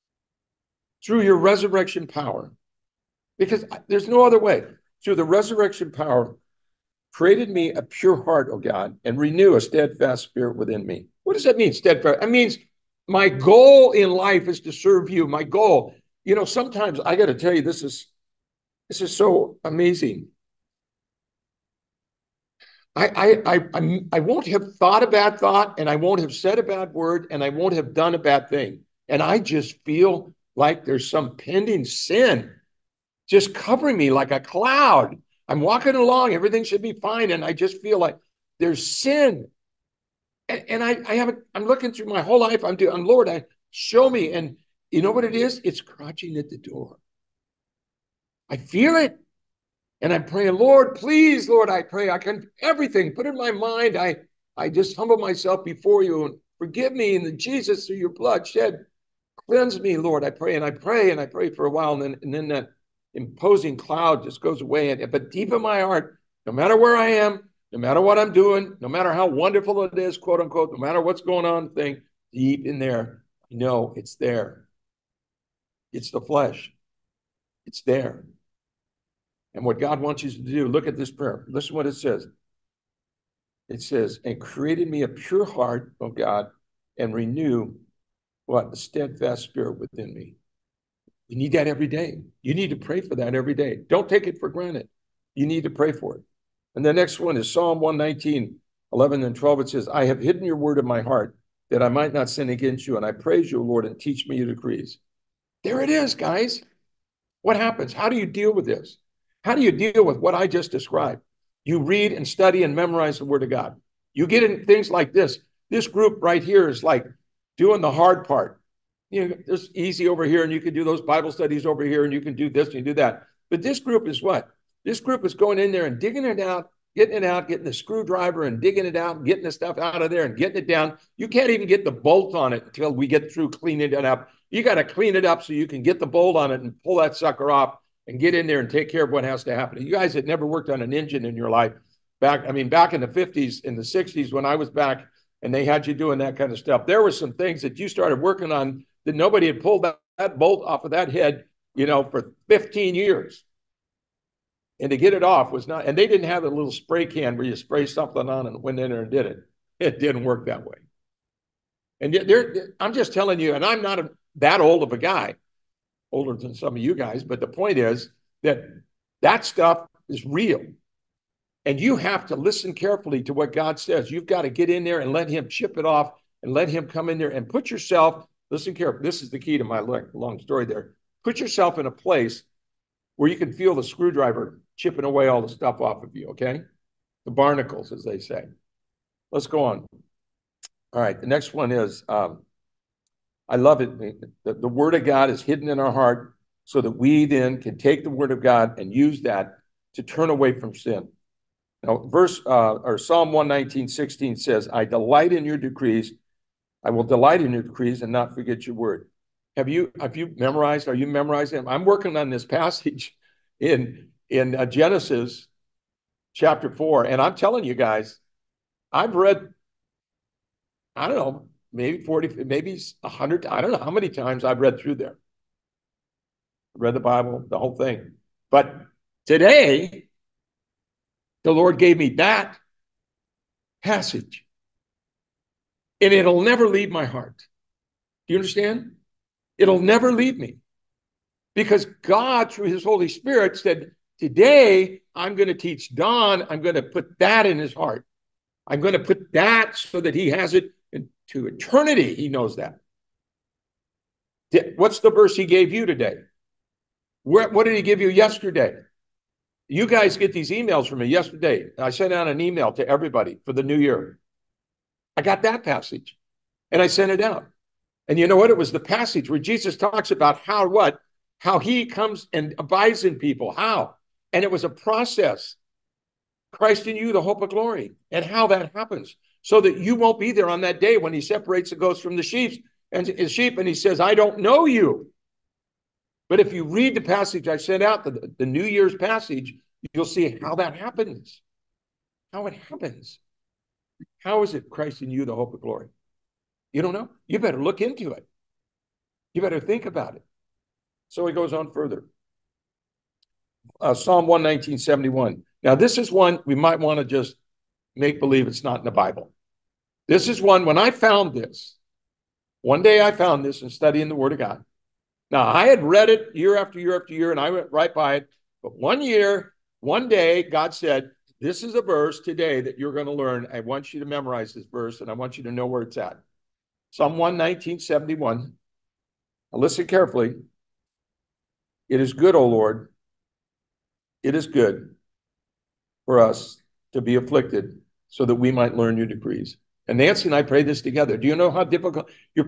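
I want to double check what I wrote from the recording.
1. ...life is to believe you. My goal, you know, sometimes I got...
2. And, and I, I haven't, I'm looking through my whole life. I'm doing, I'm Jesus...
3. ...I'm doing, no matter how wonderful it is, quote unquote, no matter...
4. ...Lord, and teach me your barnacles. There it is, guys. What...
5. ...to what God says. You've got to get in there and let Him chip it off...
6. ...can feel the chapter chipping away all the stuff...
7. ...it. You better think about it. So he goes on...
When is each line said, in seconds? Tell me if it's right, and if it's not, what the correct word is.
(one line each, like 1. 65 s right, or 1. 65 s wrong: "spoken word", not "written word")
1. 14 s wrong: "serve", not "believe"
2. 40 s wrong: "Lord", not "Jesus"
3. 68 s right
4. 103 s wrong: "decrees", not "barnacles"
5. 173 s right
6. 183 s wrong: "screwdriver", not "chapter"
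7. 298 s right.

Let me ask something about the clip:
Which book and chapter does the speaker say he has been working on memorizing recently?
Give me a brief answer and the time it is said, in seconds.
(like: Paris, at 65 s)
Genesis chapter 4, at 214 s.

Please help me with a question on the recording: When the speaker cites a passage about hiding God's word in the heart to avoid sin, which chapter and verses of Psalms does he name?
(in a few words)
Psalm 119:11-12.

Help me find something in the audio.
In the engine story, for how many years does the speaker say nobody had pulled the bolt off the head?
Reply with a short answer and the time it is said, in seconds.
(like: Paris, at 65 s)
15, at 152 s.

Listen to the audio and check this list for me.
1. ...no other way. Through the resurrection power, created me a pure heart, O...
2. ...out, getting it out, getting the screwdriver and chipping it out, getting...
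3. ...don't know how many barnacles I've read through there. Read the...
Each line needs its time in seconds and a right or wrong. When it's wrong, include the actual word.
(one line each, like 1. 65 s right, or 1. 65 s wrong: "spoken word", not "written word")
1. 4 s right
2. 126 s wrong: "digging", not "chipping"
3. 223 s wrong: "times", not "barnacles".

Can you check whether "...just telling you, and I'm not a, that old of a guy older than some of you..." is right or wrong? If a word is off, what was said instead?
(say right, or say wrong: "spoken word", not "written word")
right.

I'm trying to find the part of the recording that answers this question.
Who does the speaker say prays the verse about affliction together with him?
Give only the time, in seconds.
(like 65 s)
339 s.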